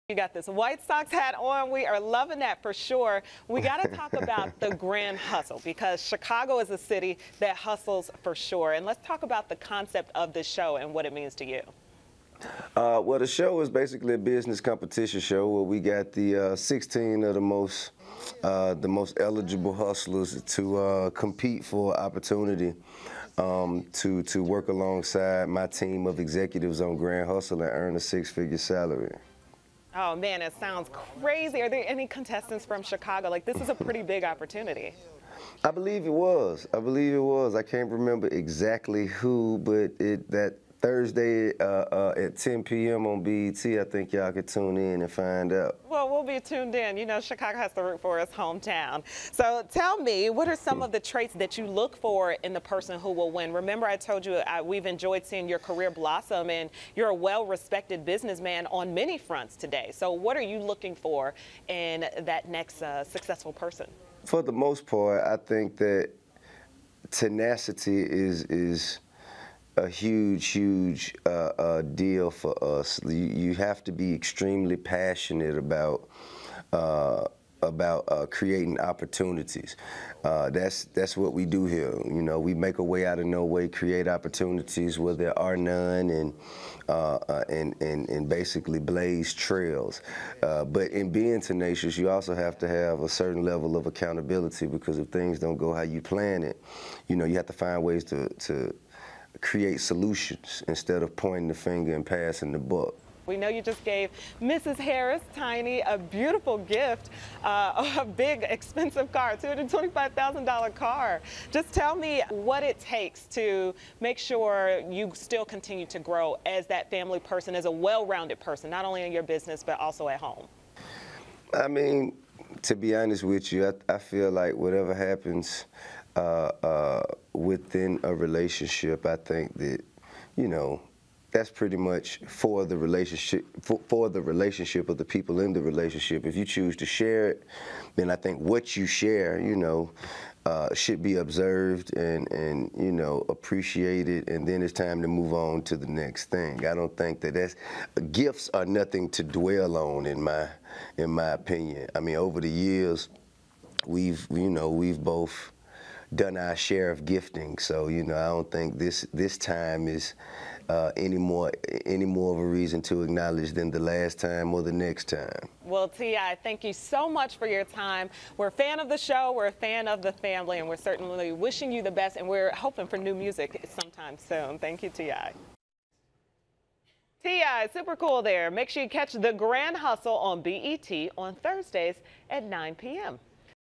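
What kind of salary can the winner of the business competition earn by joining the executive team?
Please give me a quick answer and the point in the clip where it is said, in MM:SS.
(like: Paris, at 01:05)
six-figure salary, at 00:27.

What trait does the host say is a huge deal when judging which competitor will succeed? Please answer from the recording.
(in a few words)
tenacity.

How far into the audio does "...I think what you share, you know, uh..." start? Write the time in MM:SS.
02:18.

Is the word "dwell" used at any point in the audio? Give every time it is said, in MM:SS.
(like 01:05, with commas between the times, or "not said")
02:29.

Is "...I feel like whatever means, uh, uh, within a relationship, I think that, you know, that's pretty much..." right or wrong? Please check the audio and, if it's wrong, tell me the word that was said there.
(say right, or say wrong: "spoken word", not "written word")
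wrong: "happens", not "means".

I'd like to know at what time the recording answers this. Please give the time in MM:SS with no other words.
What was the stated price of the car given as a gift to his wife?
01:49.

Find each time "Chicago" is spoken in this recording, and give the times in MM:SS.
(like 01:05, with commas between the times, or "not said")
00:06, 00:32, 00:47.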